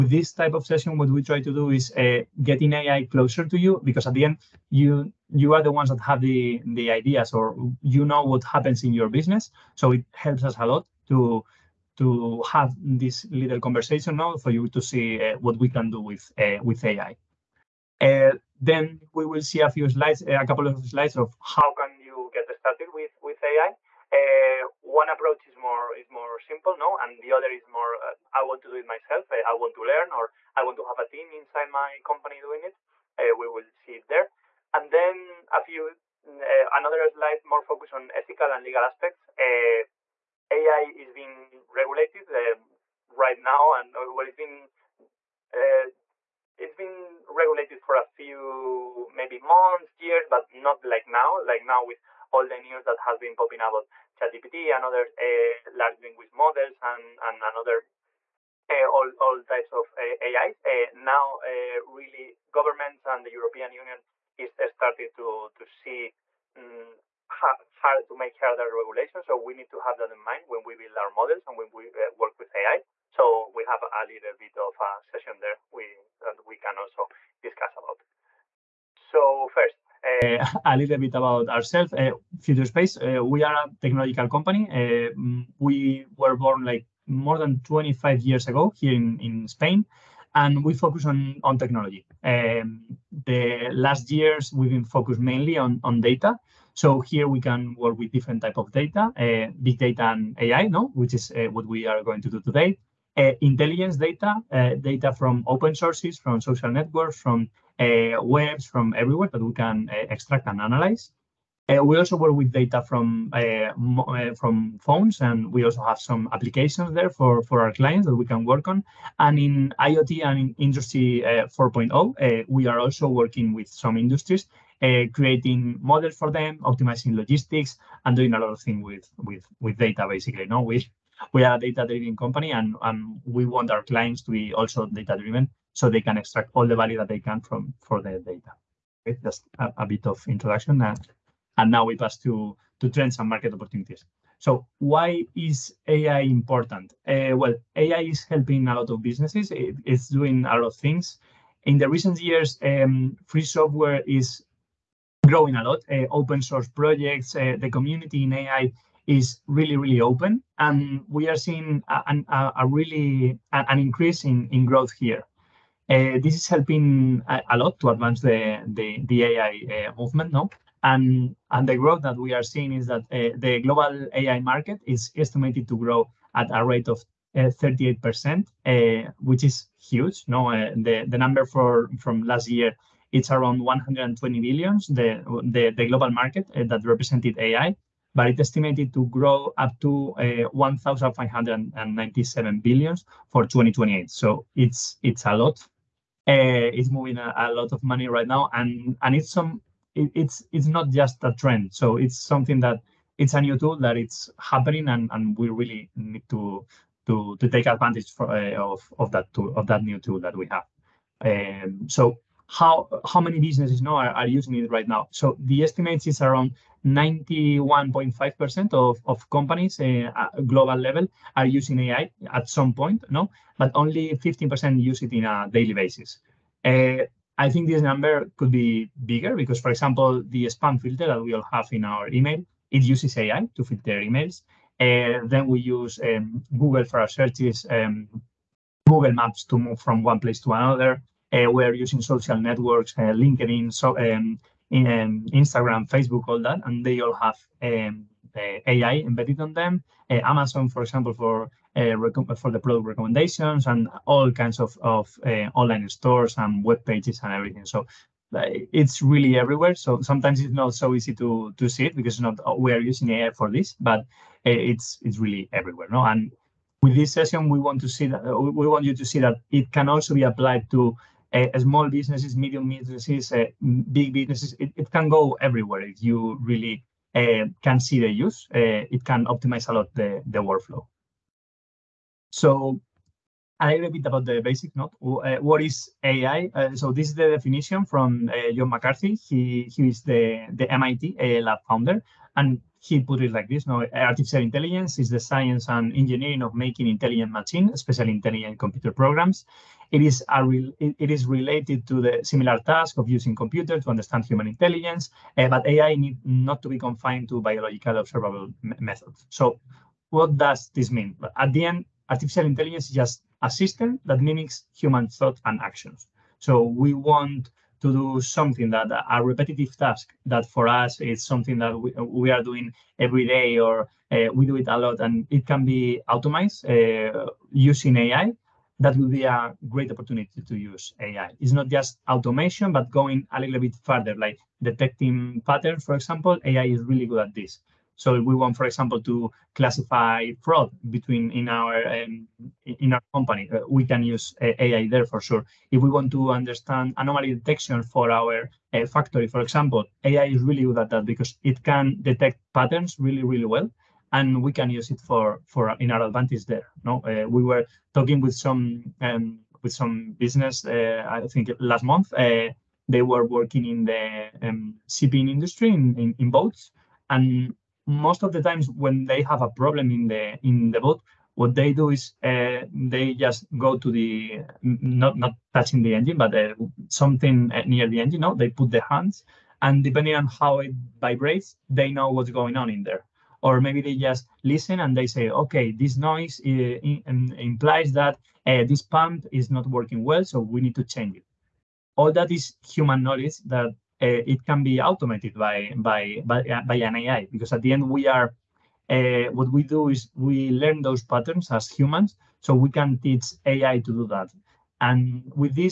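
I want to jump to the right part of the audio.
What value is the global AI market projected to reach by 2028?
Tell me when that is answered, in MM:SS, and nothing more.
03:10.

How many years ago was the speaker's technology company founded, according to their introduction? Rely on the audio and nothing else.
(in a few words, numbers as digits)
more than 25 years.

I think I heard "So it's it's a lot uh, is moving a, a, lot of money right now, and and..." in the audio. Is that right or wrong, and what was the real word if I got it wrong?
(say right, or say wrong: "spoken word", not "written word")
right.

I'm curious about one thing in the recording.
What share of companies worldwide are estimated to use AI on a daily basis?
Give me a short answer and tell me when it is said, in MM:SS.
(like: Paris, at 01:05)
15%, at 03:44.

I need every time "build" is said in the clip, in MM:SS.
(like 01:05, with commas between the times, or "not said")
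01:10.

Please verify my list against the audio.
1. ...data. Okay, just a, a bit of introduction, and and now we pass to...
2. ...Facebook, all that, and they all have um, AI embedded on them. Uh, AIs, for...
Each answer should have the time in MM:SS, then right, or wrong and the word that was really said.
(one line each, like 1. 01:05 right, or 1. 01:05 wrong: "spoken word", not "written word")
1. 02:18 right
2. 04:05 wrong: "Amazon", not "AIs".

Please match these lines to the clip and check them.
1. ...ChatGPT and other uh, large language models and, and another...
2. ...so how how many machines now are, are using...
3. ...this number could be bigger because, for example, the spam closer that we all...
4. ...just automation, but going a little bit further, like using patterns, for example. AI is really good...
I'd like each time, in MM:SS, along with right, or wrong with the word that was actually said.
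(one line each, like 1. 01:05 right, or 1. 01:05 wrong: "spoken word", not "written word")
1. 00:54 right
2. 03:31 wrong: "businesses", not "machines"
3. 03:47 wrong: "filter", not "closer"
4. 05:31 wrong: "detecting", not "using".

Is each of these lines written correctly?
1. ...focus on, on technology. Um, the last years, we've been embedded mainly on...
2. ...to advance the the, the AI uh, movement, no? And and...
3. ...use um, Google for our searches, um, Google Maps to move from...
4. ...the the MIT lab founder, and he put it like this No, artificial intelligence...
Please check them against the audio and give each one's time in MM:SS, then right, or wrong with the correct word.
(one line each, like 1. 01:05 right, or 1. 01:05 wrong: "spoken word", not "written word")
1. 01:30 wrong: "focused", not "embedded"
2. 02:47 right
3. 03:55 right
4. 04:50 right.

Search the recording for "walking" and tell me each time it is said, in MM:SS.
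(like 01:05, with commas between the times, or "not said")
not said.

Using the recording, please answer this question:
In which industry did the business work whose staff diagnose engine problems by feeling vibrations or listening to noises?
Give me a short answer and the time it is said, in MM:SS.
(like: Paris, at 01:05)
shipping industry, at 06:04.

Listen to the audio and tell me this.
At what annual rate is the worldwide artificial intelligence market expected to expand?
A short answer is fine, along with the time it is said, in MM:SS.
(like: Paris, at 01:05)
38%, at 02:57.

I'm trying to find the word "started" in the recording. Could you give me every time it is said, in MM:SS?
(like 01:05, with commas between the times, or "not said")
00:22, 01:04.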